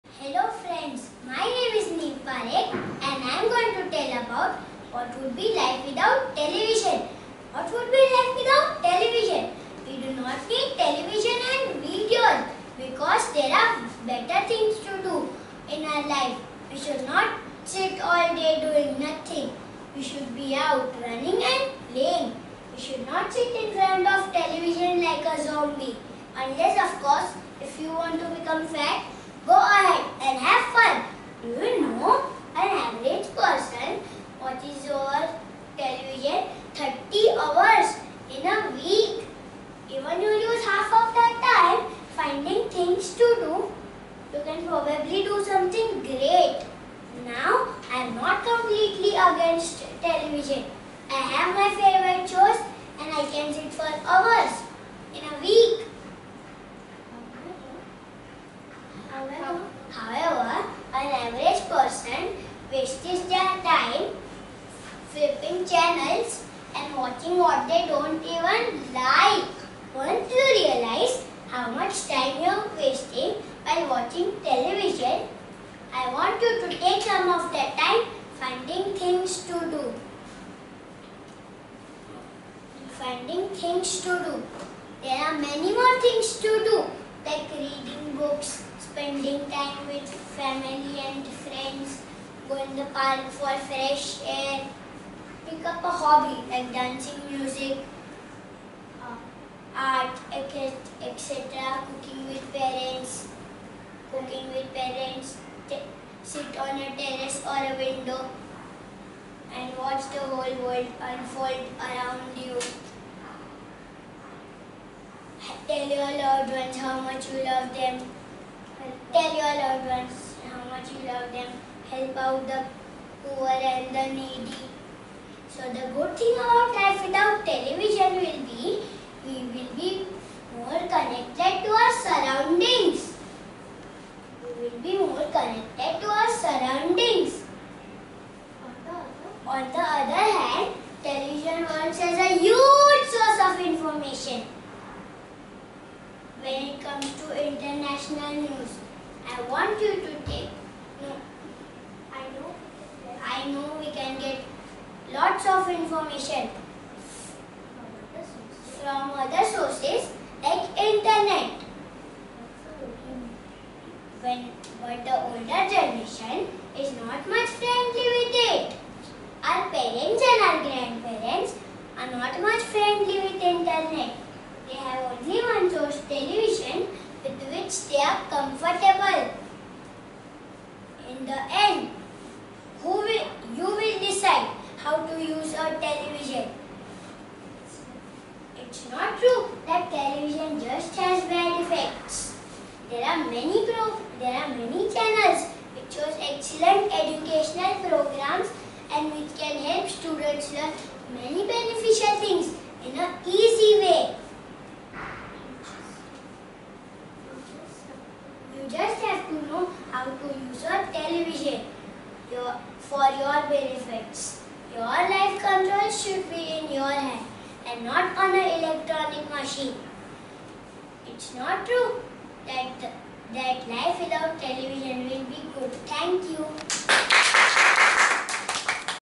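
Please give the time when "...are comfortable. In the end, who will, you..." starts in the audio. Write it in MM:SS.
02:57.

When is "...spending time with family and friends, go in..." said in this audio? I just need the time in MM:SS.
01:28.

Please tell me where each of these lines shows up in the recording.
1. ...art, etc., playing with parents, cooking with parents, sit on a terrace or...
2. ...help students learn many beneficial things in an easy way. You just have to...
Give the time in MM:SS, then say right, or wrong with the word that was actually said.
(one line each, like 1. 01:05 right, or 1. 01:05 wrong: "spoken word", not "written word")
1. 01:39 wrong: "cooking", not "playing"
2. 03:19 right.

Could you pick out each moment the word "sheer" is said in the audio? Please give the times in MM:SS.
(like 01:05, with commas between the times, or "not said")
not said.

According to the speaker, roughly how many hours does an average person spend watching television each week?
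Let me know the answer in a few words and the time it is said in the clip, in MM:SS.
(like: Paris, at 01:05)
30 hours, at 00:36.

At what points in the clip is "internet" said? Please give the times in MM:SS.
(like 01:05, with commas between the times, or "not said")
02:40, 02:53.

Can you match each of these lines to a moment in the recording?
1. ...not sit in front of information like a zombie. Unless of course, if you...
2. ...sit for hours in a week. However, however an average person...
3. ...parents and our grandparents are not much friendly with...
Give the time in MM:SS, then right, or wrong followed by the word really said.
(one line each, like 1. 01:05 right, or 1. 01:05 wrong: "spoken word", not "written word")
1. 00:23 wrong: "television", not "information"
2. 00:53 right
3. 02:49 right.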